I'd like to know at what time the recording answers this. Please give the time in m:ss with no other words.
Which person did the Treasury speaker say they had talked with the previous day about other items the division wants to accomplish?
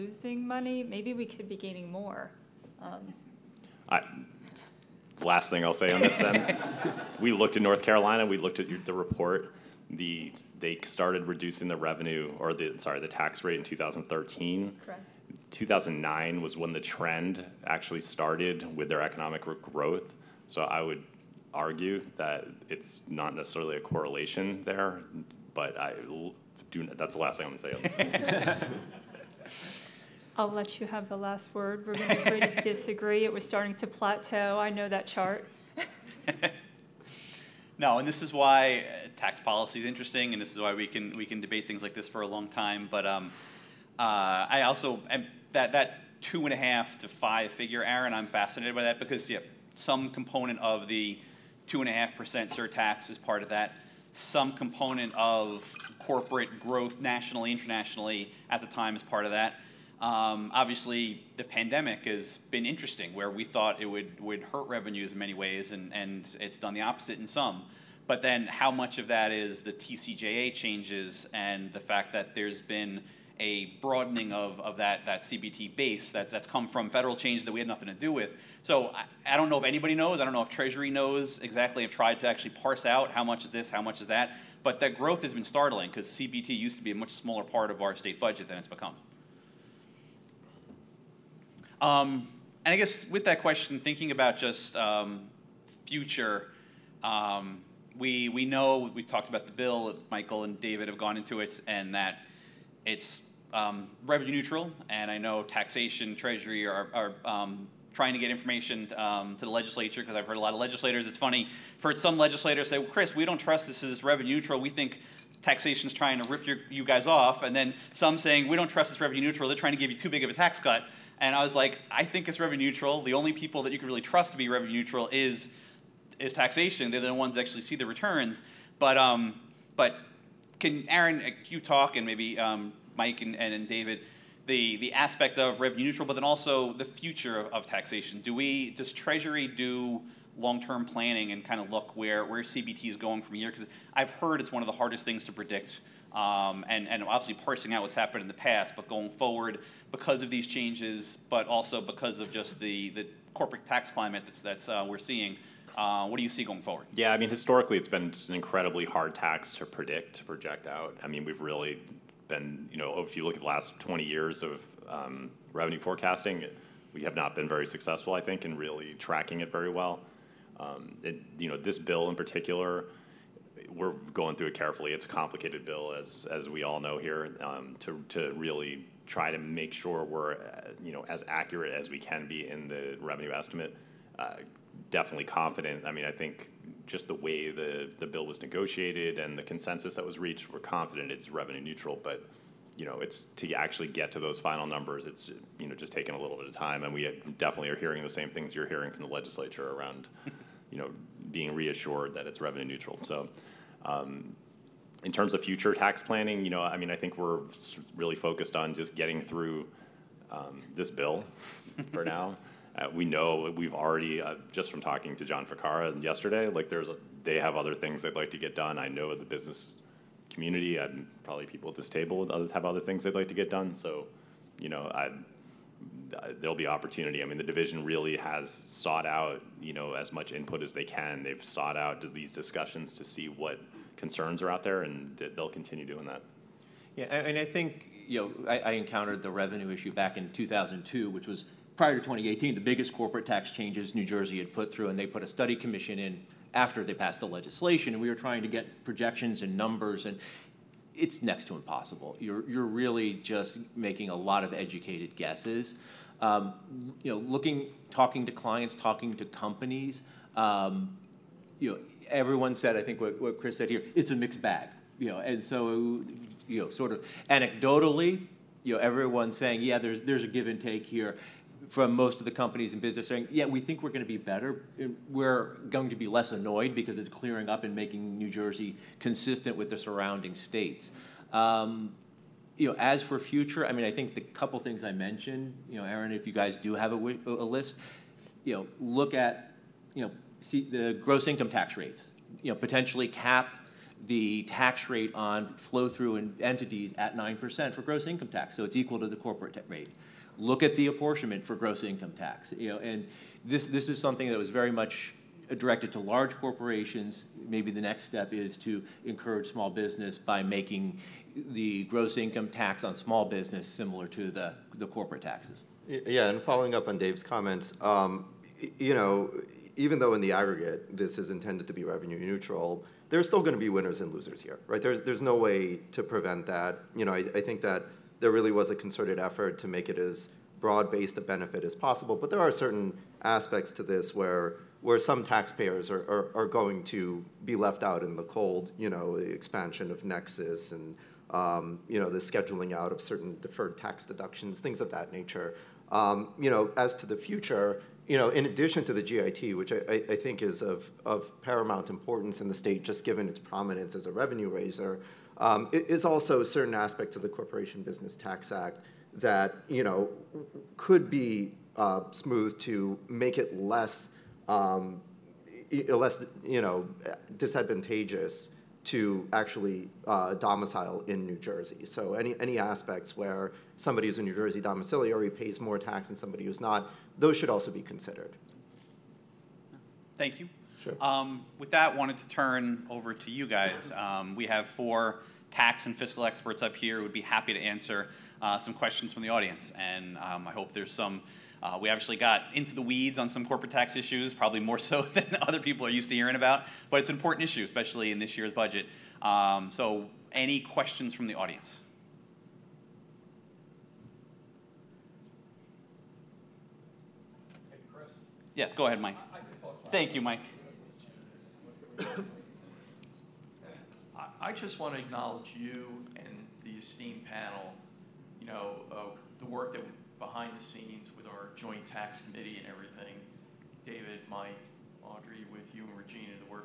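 3:35.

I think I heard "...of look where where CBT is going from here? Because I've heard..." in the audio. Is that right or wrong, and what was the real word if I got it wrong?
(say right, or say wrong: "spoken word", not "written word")
right.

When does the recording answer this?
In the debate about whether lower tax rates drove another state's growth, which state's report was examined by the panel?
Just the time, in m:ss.
0:07.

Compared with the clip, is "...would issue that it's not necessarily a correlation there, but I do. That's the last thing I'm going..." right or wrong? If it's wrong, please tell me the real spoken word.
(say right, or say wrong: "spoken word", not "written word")
wrong: "argue", not "issue".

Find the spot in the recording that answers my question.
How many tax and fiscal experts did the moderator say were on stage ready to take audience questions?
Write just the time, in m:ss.
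6:24.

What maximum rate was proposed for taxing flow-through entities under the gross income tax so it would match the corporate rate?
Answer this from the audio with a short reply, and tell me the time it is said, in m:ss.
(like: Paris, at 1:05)
9%, at 4:57.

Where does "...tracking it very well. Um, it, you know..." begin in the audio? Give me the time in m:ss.
2:48.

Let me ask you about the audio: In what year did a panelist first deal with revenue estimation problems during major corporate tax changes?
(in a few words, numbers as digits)
2002.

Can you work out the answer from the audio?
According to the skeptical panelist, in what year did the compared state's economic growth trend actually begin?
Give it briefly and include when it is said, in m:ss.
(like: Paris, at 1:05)
2009, at 0:15.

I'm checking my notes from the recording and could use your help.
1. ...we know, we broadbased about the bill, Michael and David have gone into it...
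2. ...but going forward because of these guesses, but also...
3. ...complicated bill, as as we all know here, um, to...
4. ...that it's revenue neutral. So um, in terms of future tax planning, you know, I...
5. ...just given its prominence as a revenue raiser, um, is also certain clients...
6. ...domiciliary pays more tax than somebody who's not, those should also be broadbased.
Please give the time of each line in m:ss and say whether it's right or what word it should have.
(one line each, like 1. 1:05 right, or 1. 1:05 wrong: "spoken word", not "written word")
1. 1:38 wrong: "talked", not "broadbased"
2. 2:28 wrong: "changes", not "guesses"
3. 2:55 right
4. 3:22 right
5. 5:52 wrong: "aspects", not "clients"
6. 6:14 wrong: "considered", not "broadbased".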